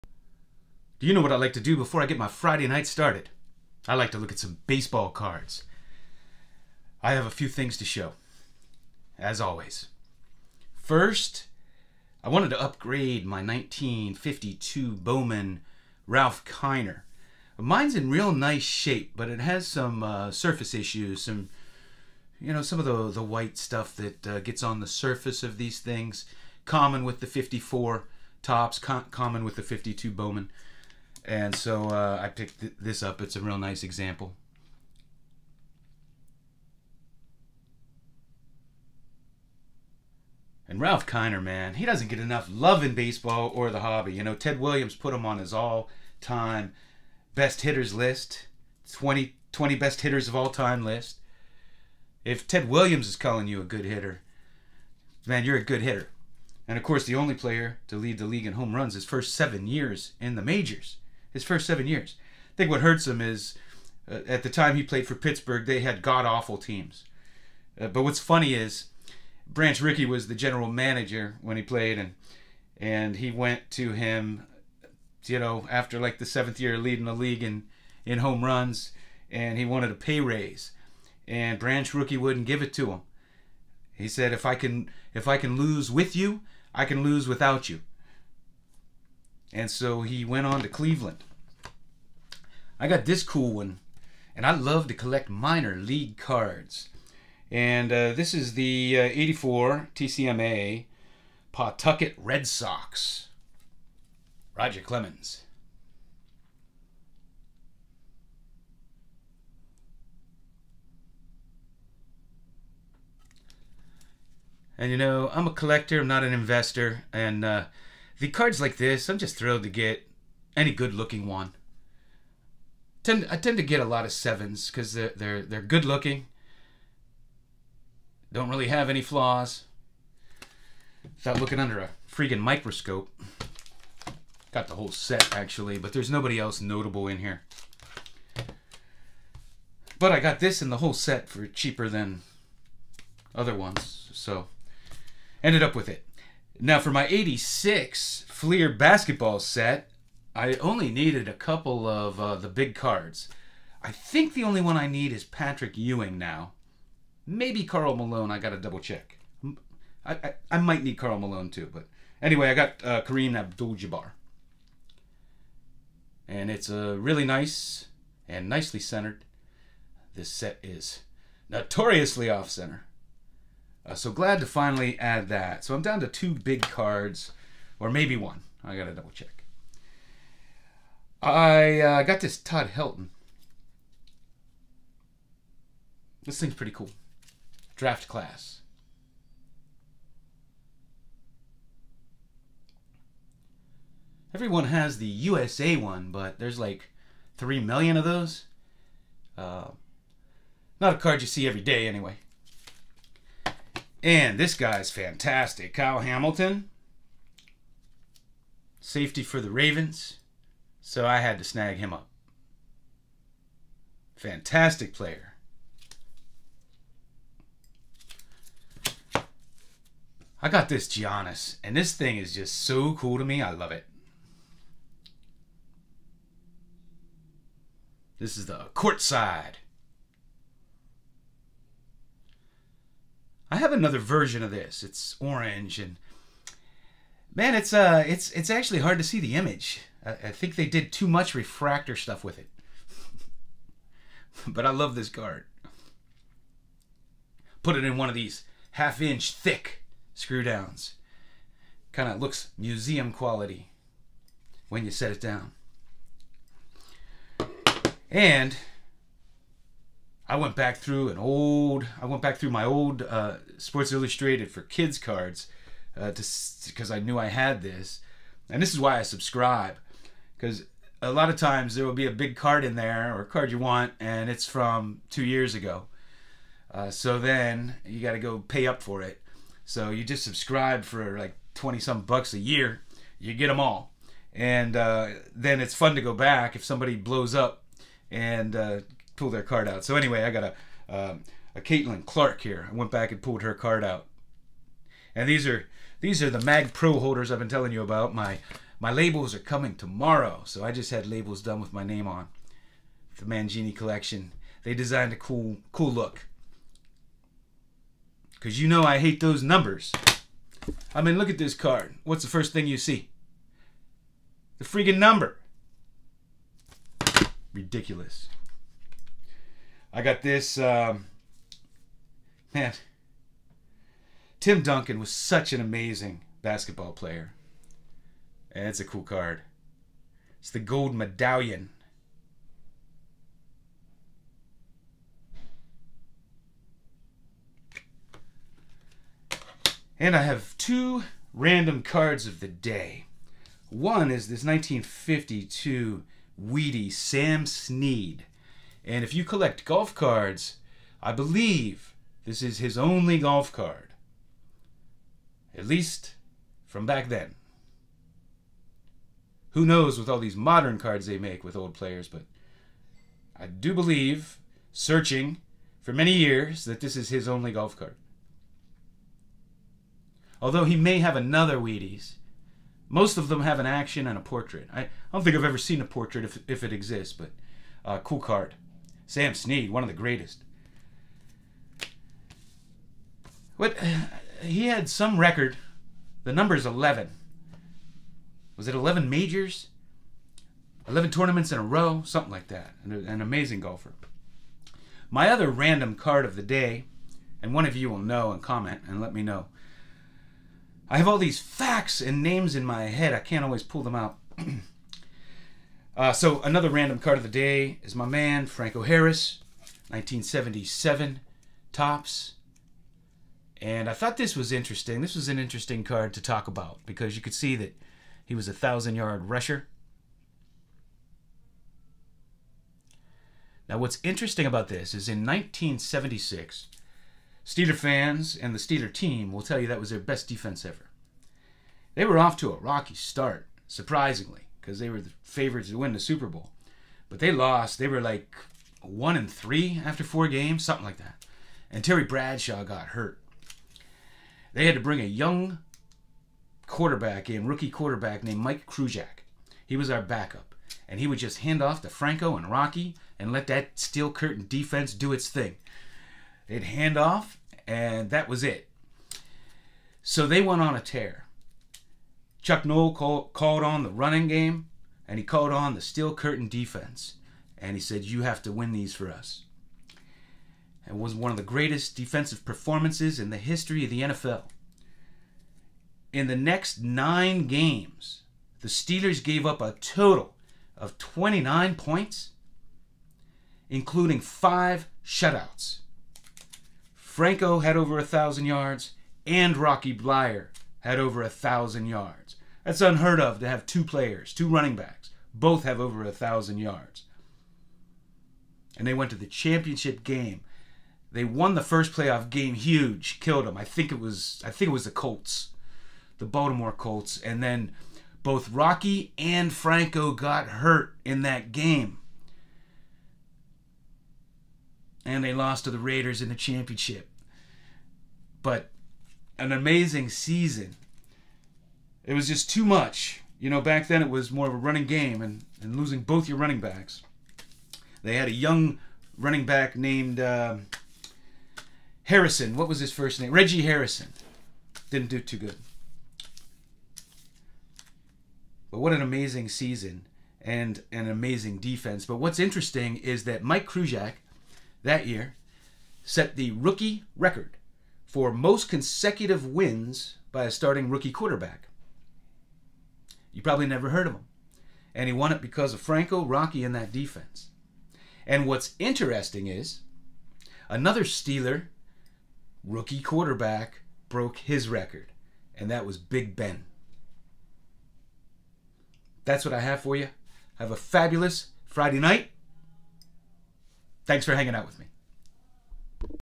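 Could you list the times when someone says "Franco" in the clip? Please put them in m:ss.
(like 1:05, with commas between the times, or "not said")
6:48, 7:31, 8:06, 8:29, 9:15.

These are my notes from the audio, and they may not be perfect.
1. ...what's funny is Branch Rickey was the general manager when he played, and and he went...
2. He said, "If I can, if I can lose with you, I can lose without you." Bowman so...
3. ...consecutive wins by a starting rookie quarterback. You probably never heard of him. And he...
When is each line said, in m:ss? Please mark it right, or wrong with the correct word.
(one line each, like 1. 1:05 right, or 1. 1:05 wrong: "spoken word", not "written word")
1. 1:08 right
2. 1:23 wrong: "And", not "Bowman"
3. 9:08 right.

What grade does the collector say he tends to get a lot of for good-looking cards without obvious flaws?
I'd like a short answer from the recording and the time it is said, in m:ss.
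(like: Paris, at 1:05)
7, at 2:04.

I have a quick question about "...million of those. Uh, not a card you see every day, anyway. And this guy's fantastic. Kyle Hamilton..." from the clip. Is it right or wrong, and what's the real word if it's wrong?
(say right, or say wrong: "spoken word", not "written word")
right.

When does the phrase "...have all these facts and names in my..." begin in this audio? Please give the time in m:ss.
6:40.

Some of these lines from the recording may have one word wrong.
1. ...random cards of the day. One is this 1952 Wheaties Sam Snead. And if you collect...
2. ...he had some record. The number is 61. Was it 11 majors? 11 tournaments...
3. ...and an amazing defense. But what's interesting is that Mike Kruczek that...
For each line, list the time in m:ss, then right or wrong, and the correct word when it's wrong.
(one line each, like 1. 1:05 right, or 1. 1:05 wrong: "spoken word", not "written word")
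1. 5:41 right
2. 6:24 wrong: "11", not "61"
3. 9:00 right.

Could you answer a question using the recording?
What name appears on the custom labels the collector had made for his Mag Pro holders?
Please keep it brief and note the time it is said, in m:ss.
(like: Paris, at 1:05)
The Mangini collection, at 5:03.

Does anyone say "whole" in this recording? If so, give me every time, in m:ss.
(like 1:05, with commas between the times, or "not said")
2:14, 2:20.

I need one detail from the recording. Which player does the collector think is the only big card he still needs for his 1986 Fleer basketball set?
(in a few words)
Patrick Ewing.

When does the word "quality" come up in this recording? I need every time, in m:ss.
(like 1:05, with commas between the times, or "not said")
4:13.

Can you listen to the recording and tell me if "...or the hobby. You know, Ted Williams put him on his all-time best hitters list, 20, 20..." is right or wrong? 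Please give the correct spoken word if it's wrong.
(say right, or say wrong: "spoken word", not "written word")
right.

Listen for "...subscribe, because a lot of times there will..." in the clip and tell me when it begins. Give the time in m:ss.
4:29.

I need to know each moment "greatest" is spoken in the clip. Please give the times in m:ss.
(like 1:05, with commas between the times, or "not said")
6:19, 7:51.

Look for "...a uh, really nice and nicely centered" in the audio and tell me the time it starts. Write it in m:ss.
2:46.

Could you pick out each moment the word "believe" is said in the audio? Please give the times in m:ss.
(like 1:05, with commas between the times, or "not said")
5:51, 6:03.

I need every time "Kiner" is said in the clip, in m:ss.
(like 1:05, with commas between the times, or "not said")
0:16, 0:41.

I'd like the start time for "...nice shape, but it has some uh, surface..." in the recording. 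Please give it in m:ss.
0:18.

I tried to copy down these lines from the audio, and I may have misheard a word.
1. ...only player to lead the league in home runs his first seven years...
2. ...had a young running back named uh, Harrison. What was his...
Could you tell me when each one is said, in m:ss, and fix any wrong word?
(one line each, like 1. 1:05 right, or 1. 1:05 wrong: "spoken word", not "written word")
1. 0:57 right
2. 8:48 right.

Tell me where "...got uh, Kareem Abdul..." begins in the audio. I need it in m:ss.
2:42.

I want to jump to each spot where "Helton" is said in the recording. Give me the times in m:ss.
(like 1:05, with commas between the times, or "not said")
3:02.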